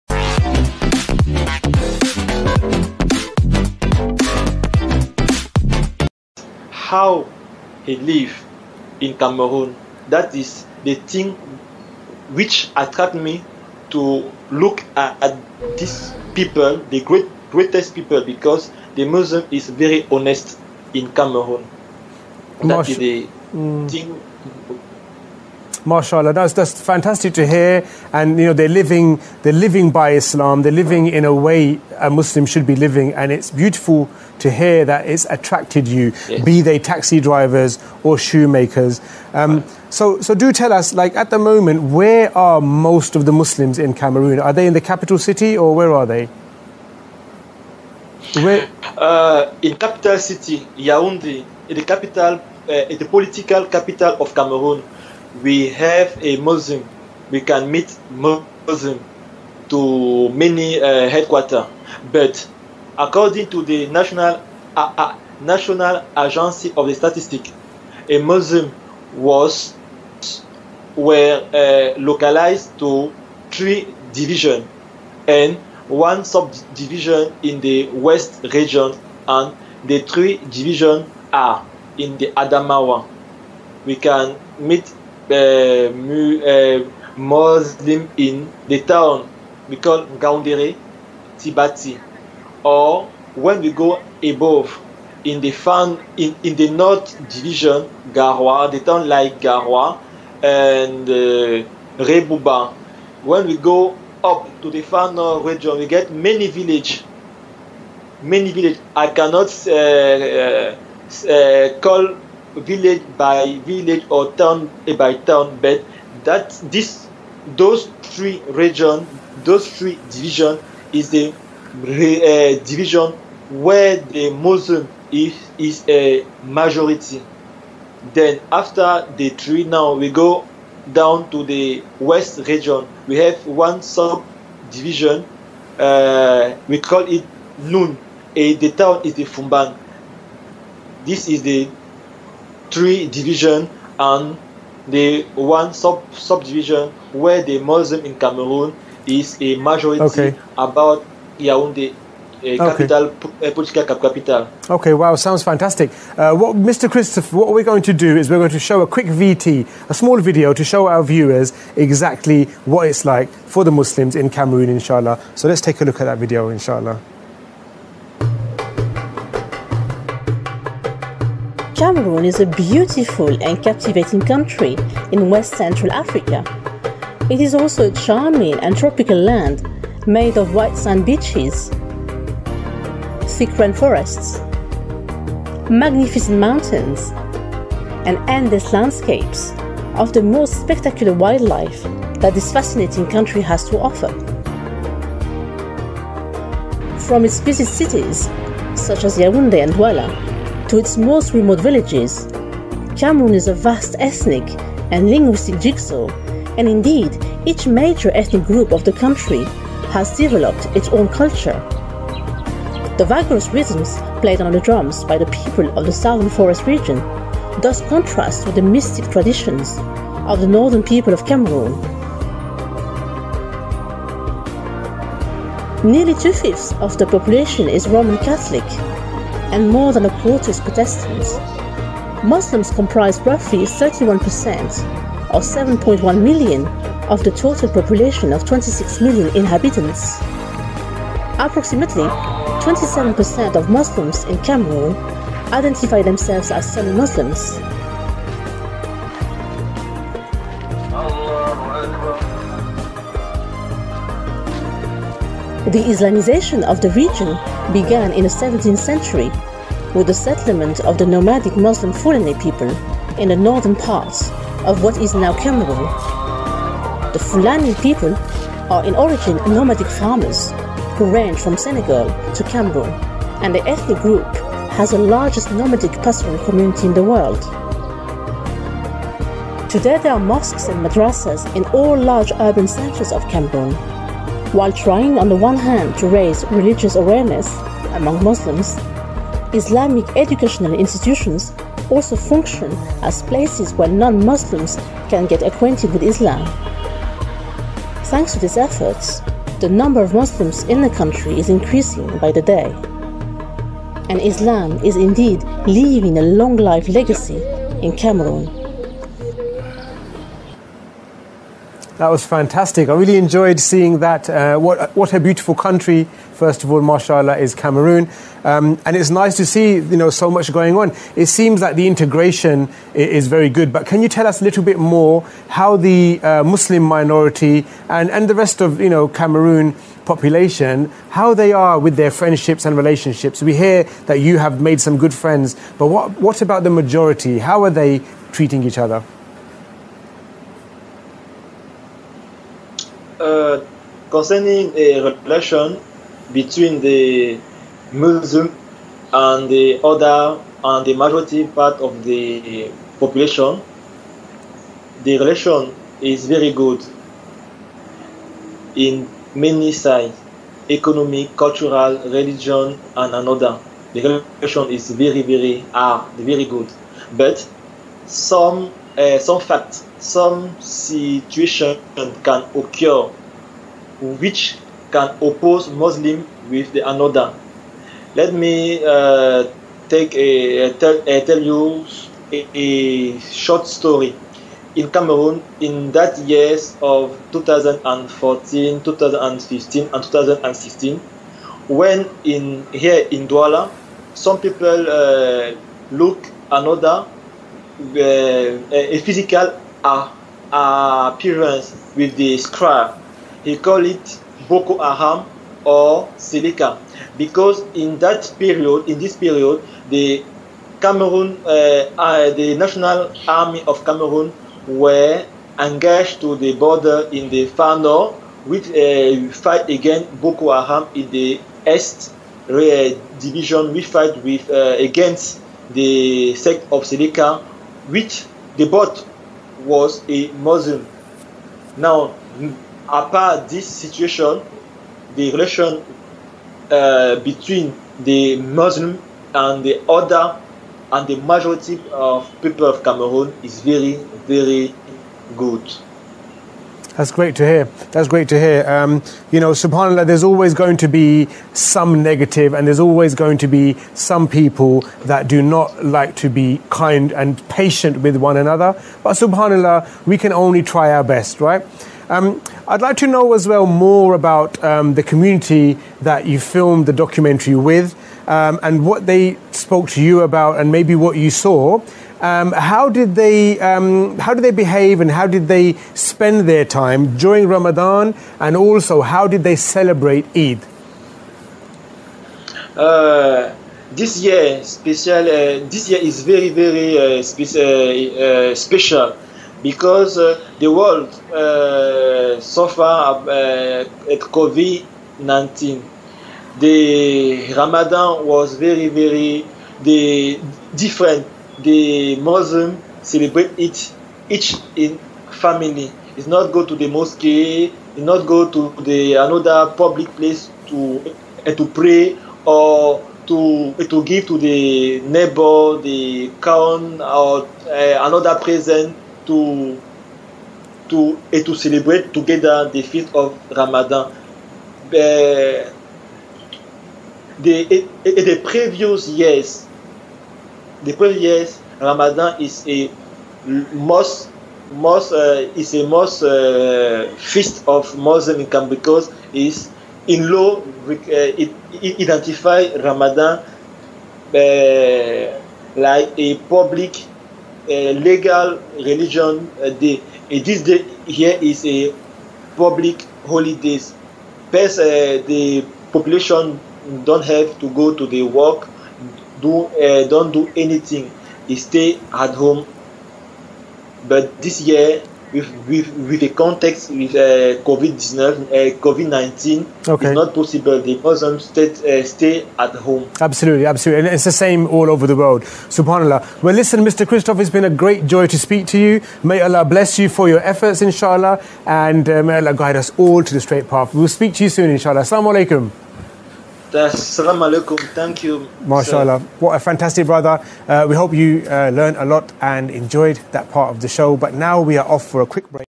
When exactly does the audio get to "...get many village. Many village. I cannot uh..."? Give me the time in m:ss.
1:45.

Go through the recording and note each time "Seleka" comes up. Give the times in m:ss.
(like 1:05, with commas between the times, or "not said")
6:46, 7:06.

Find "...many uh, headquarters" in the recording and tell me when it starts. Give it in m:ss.
1:00.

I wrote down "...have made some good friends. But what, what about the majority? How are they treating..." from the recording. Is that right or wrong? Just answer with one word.
right.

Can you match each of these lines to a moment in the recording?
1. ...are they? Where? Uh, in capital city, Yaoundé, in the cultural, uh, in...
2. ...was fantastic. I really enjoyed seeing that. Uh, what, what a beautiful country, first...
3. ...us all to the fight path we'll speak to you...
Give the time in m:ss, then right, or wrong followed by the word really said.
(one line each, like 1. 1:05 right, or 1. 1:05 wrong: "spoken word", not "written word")
1. 0:45 wrong: "capital", not "cultural"
2. 5:12 right
3. 9:42 wrong: "straight", not "fight".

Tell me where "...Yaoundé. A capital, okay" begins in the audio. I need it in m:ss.
2:31.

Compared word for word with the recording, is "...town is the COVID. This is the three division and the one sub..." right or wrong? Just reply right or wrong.
wrong.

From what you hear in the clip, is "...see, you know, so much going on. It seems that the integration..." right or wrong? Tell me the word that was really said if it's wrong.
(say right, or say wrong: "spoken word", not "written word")
right.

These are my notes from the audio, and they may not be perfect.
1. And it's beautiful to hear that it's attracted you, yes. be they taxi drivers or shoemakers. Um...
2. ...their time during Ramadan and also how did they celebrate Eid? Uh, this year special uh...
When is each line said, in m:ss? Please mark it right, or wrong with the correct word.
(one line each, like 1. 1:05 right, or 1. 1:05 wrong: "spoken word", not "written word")
1. 0:33 right
2. 7:56 right.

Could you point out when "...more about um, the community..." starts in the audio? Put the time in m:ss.
7:43.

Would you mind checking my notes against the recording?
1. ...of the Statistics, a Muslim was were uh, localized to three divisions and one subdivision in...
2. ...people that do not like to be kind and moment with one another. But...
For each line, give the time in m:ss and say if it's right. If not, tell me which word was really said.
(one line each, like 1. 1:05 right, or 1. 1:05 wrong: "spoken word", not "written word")
1. 1:06 right
2. 7:34 wrong: "patient", not "moment".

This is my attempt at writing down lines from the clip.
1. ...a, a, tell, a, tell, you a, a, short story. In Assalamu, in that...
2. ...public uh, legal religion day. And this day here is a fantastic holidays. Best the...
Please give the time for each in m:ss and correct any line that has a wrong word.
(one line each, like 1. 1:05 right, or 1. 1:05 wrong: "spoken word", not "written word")
1. 6:20 wrong: "Cameroon", not "Assalamu"
2. 9:06 wrong: "public", not "fantastic".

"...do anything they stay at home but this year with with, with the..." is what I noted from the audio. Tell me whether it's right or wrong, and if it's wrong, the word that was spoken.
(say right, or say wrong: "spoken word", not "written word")
right.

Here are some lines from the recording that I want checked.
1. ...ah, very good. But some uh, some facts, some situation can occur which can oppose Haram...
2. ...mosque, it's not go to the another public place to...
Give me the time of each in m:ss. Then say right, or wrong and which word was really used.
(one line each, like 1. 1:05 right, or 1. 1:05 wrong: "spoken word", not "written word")
1. 6:05 wrong: "Muslim", not "Haram"
2. 8:26 right.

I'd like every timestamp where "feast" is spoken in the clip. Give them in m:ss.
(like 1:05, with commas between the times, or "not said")
8:42, 8:57.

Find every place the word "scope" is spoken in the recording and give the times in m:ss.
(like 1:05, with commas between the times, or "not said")
not said.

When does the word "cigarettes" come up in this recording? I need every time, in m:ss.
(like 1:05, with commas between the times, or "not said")
not said.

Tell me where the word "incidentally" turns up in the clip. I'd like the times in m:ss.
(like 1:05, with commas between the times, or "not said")
not said.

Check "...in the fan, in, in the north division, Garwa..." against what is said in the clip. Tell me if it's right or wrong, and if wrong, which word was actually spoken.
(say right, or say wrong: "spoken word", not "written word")
right.